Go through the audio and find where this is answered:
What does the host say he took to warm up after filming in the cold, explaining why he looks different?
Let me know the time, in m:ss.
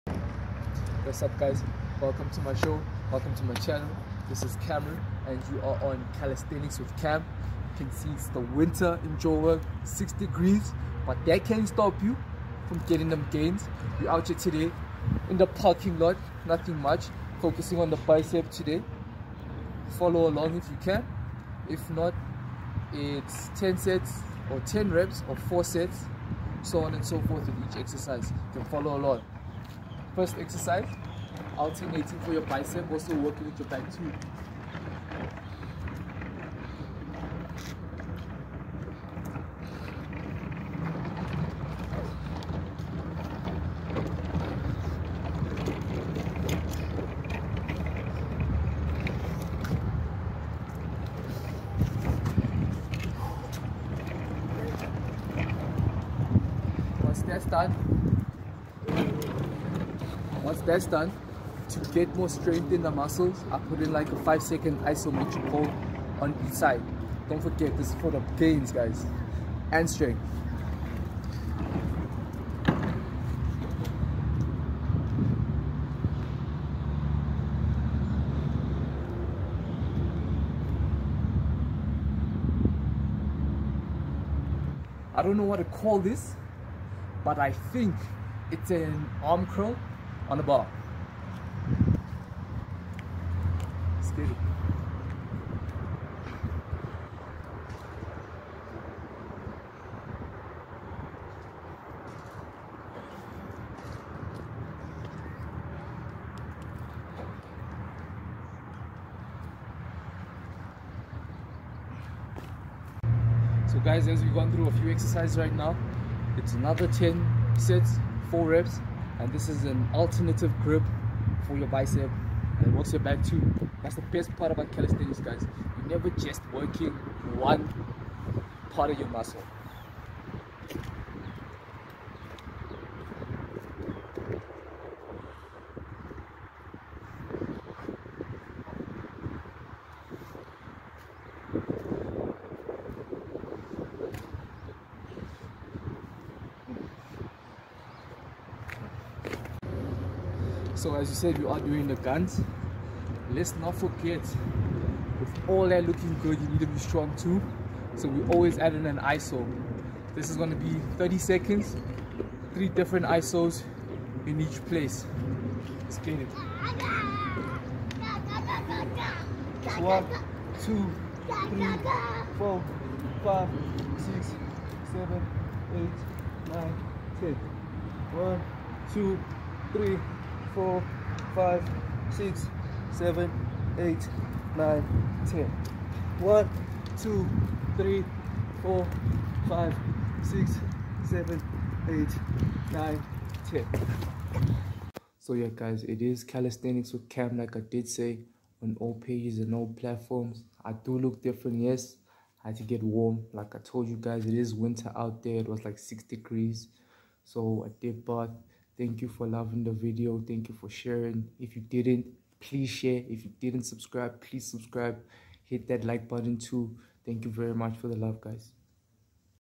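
3:28.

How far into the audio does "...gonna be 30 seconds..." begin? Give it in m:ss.
2:40.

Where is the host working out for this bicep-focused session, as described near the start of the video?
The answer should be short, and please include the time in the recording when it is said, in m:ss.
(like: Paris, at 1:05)
parking lot, at 0:15.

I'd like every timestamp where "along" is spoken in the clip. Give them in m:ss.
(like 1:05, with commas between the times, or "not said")
0:20, 0:28.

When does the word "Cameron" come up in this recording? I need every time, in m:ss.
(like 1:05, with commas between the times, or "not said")
0:04.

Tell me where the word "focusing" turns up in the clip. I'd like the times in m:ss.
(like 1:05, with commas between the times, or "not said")
0:17.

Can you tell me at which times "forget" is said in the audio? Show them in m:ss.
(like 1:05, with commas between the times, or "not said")
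1:07, 2:33.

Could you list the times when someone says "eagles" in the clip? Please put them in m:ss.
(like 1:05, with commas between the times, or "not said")
not said.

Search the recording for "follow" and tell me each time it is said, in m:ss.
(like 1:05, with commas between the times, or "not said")
0:19, 0:28.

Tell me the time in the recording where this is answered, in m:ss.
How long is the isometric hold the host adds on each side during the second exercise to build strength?
1:04.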